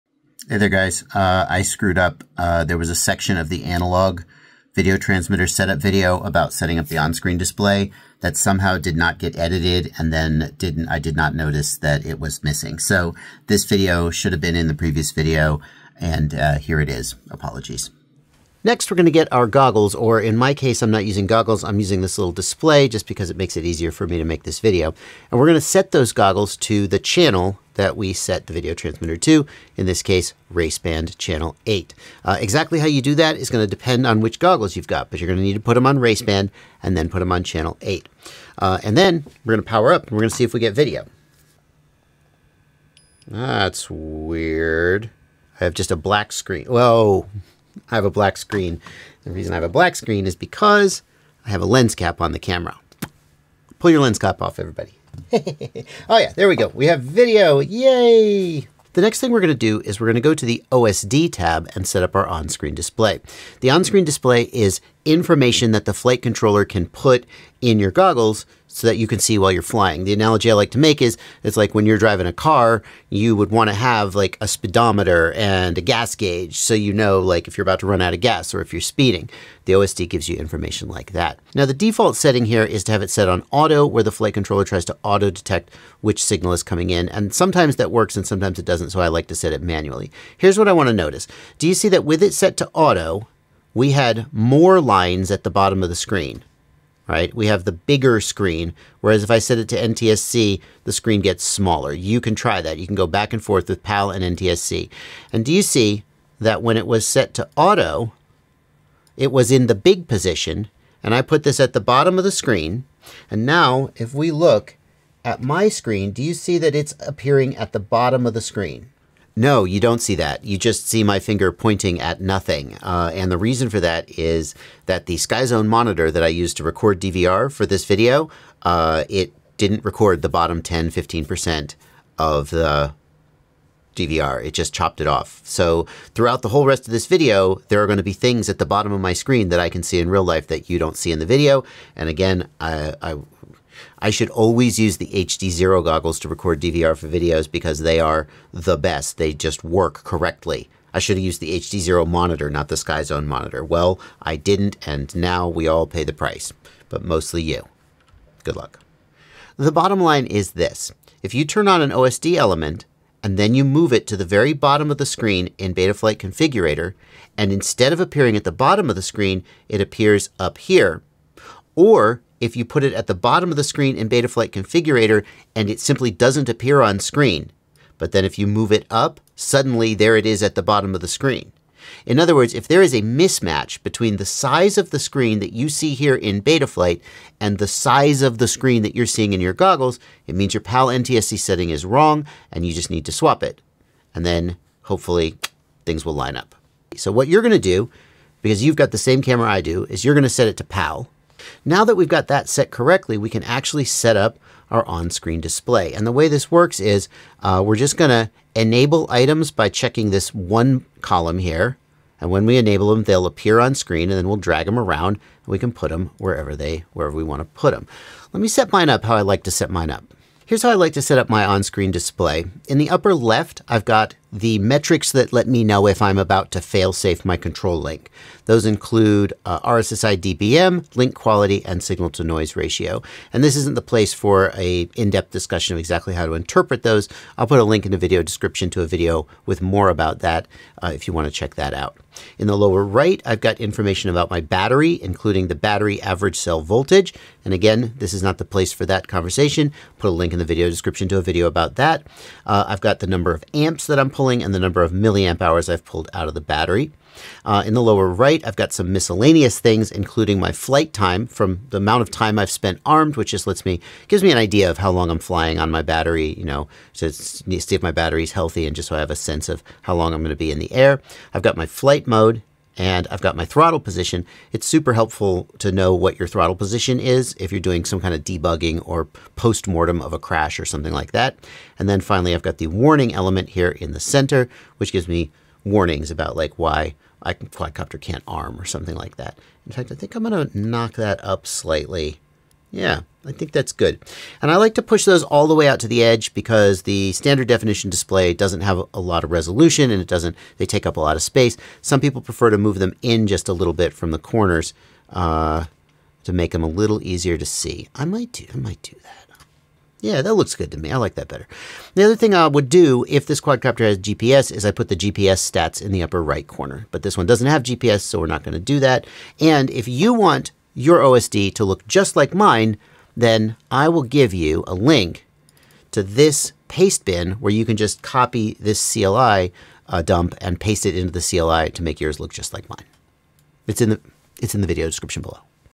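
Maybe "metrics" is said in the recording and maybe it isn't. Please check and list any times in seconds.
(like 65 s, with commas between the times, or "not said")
224 s.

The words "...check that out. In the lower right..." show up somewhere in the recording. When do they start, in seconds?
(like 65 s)
241 s.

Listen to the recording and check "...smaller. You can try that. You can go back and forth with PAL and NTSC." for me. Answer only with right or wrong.
right.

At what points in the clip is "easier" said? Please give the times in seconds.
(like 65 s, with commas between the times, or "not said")
23 s, 307 s.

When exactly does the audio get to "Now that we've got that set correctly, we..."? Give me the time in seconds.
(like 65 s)
201 s.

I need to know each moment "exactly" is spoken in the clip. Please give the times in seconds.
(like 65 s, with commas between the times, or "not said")
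32 s, 235 s.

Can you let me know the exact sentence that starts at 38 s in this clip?
Uh, and then we're going to power up and we're going to see if we get video.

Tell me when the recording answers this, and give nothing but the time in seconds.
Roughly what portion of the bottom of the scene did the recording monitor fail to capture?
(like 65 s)
130 s.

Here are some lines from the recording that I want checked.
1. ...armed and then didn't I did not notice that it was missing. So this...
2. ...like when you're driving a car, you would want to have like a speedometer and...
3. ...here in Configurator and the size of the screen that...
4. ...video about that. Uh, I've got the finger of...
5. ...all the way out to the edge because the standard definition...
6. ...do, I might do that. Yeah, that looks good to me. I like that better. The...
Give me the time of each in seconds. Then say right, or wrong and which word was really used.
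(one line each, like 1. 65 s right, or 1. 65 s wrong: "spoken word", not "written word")
1. 9 s wrong: "edited", not "armed"
2. 71 s right
3. 185 s wrong: "Betaflight", not "Configurator"
4. 251 s wrong: "number", not "finger"
5. 295 s right
6. 308 s right.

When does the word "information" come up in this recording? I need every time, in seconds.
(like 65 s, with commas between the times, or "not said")
65 s, 80 s, 243 s.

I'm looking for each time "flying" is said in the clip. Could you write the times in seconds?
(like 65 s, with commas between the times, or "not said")
69 s, 265 s.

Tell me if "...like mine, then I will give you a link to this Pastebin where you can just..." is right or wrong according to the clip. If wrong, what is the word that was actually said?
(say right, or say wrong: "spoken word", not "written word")
right.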